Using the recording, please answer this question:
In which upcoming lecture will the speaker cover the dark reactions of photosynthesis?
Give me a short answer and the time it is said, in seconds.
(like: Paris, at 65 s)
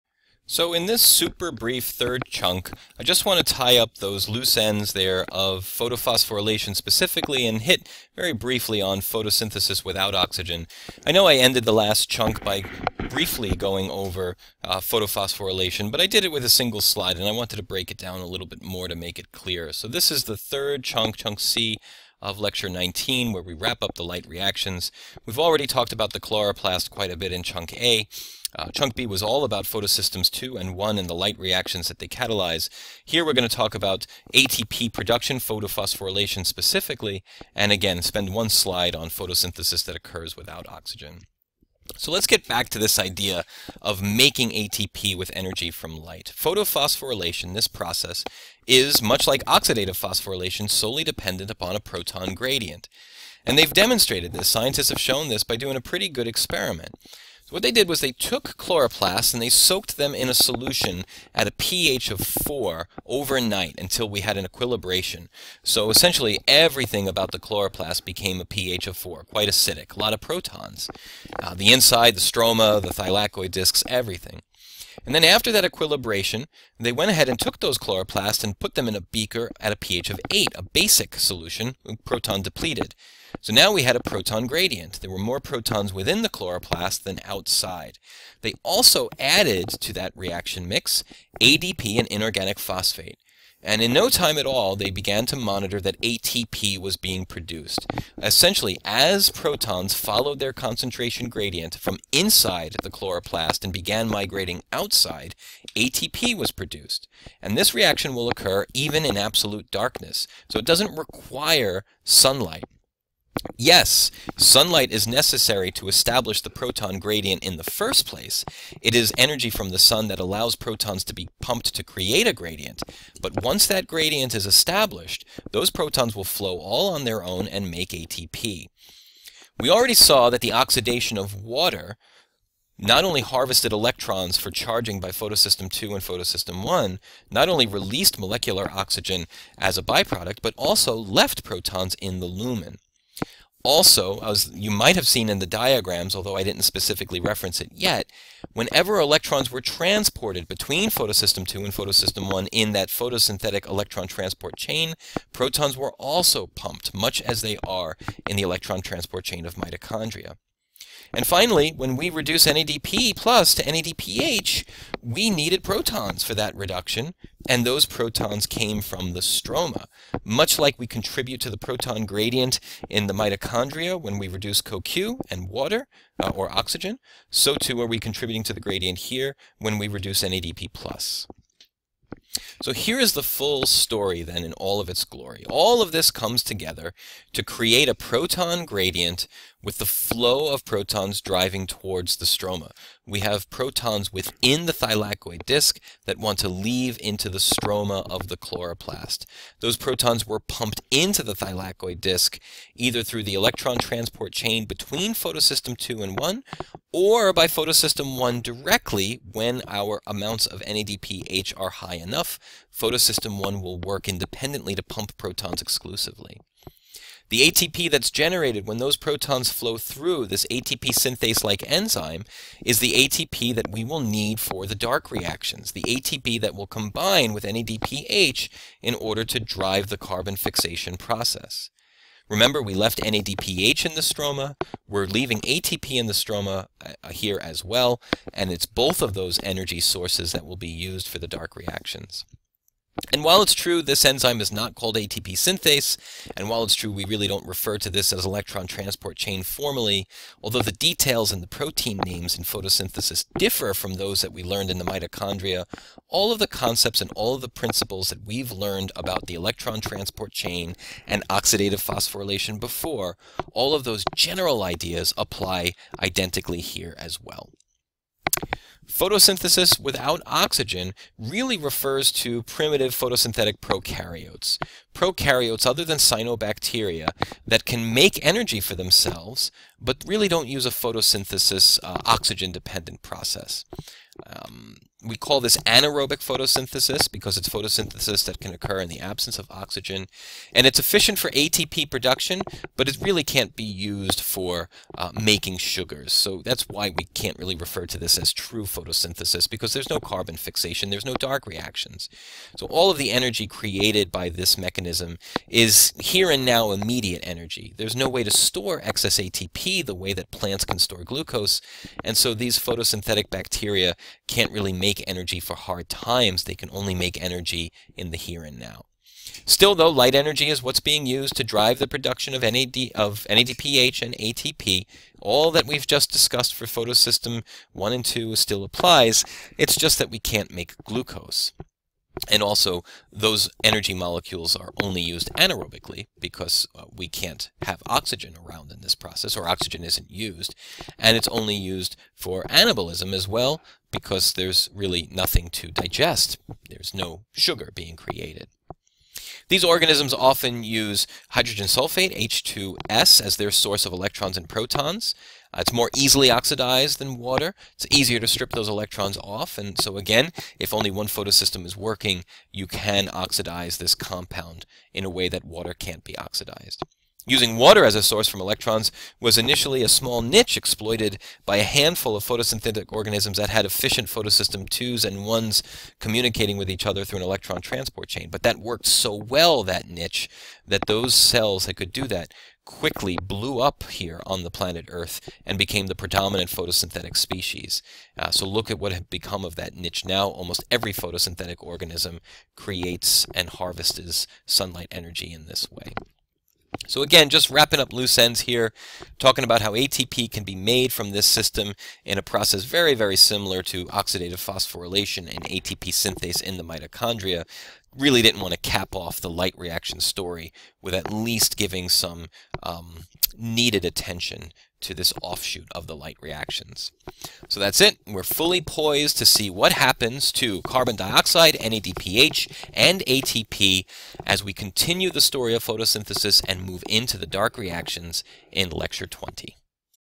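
Lecture 20, at 428 s.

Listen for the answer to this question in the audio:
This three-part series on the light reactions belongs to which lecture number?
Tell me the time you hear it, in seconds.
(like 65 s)
22 s.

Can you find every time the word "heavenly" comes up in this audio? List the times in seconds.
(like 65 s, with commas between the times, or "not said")
not said.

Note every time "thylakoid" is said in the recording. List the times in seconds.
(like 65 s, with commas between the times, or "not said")
72 s, 194 s, 201 s.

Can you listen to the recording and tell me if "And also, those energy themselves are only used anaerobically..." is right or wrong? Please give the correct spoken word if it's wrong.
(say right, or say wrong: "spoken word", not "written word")
wrong: "molecules", not "themselves".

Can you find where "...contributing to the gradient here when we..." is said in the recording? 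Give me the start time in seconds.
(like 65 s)
177 s.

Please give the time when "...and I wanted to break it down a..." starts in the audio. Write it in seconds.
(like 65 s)
17 s.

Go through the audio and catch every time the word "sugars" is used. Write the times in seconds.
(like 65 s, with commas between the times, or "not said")
295 s, 347 s.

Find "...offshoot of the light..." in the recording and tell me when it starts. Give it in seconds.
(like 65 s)
415 s.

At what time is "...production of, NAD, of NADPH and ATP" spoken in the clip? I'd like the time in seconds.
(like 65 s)
321 s.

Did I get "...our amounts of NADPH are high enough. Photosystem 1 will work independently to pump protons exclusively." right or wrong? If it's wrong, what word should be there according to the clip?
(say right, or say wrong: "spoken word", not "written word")
right.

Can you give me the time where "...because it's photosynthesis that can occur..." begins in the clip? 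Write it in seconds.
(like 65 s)
287 s.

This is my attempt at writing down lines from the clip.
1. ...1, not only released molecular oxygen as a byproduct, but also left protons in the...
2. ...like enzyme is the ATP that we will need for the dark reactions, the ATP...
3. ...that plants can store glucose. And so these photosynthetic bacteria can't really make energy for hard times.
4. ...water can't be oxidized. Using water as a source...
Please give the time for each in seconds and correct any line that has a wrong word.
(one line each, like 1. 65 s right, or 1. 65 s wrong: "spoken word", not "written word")
1. 136 s right
2. 221 s right
3. 310 s right
4. 365 s right.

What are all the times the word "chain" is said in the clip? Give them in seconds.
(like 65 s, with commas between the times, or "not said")
154 s, 159 s, 204 s, 249 s, 260 s, 378 s.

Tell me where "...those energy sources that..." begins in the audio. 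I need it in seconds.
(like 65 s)
239 s.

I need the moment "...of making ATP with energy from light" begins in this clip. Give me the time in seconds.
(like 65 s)
43 s.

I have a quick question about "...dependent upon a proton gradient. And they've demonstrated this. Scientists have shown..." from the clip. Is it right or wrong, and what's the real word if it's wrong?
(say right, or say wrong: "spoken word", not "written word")
right.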